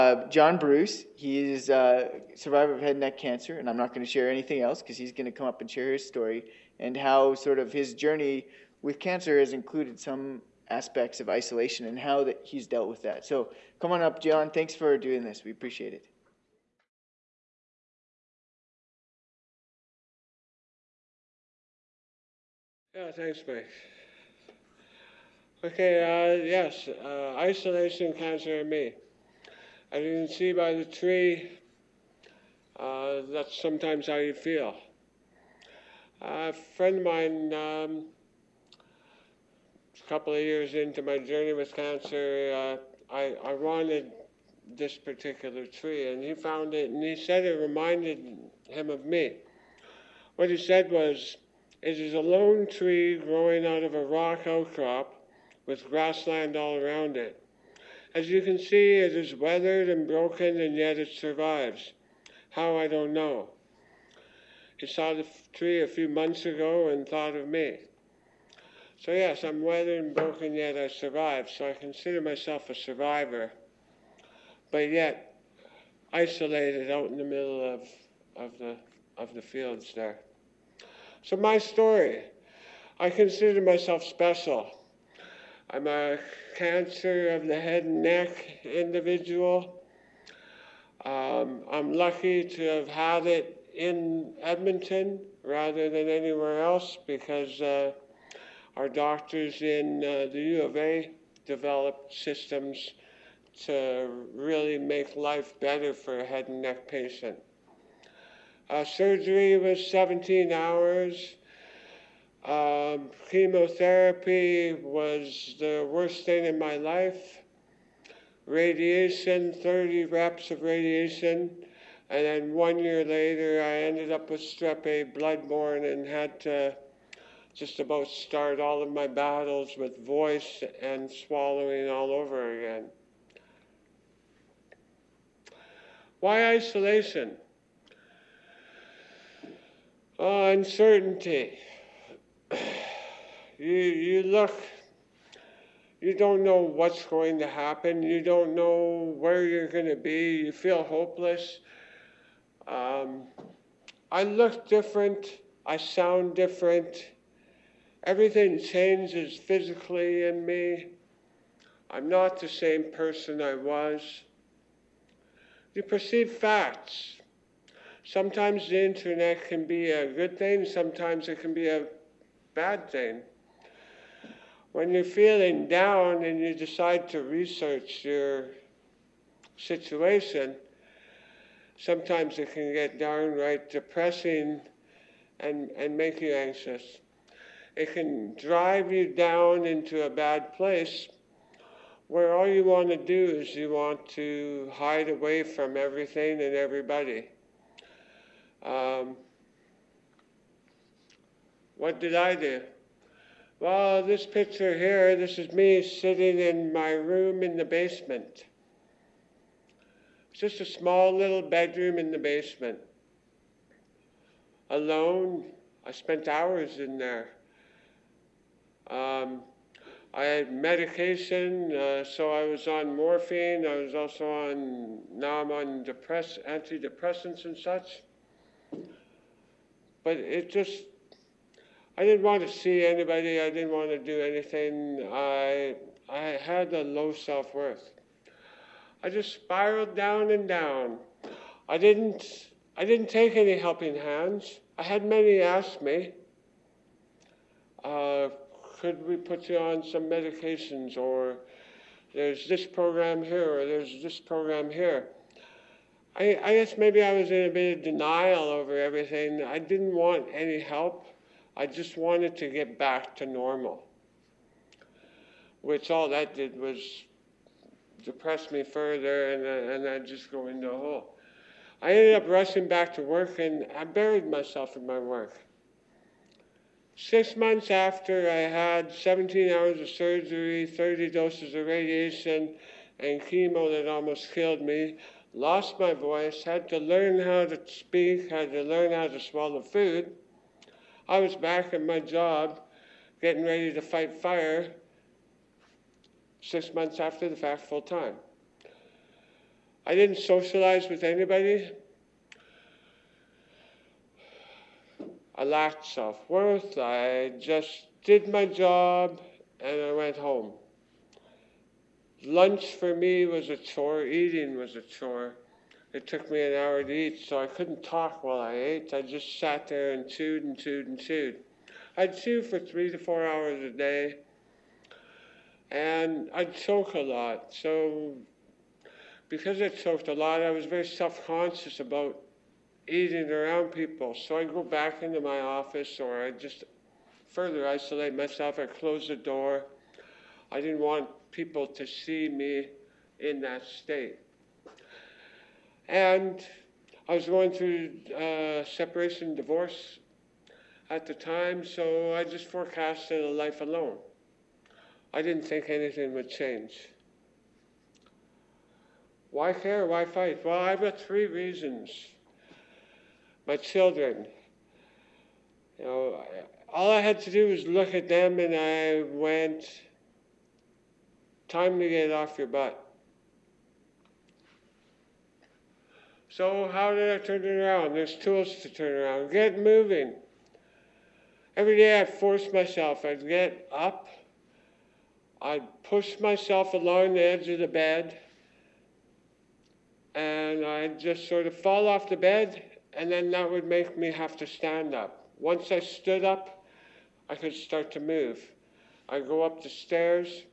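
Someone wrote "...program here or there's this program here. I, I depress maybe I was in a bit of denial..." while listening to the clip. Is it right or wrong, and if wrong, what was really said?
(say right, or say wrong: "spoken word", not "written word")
wrong: "guess", not "depress".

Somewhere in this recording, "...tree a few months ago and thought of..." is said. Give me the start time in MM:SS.
01:05.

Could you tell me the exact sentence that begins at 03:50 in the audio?
But it just, I didn't want to see anybody.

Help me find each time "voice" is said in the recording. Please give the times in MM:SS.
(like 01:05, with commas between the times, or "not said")
02:10, 04:45.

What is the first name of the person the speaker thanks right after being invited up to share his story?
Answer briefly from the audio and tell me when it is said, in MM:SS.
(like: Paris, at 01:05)
Mike, at 00:23.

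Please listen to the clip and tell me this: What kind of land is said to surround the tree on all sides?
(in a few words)
grassland.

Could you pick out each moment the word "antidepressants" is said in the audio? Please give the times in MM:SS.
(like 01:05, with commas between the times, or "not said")
03:46.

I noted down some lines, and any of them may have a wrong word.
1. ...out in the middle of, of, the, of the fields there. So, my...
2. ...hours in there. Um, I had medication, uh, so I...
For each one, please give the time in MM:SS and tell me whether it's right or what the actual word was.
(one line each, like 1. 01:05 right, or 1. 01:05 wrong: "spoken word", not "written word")
1. 01:16 right
2. 03:36 right.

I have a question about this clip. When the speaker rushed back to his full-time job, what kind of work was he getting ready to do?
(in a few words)
fight fire.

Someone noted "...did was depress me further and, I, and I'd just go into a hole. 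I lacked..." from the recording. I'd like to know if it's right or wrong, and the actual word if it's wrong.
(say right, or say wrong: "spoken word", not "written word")
wrong: "ended", not "lacked".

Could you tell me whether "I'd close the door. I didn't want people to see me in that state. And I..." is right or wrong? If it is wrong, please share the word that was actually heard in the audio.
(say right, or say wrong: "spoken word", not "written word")
right.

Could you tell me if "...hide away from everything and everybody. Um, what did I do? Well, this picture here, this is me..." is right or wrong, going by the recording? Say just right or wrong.
right.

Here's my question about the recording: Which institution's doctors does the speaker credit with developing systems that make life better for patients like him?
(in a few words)
U of A.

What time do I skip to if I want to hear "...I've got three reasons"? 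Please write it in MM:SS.
06:00.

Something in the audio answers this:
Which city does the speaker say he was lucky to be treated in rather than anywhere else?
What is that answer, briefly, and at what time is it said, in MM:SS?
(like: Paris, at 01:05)
Edmonton, at 01:34.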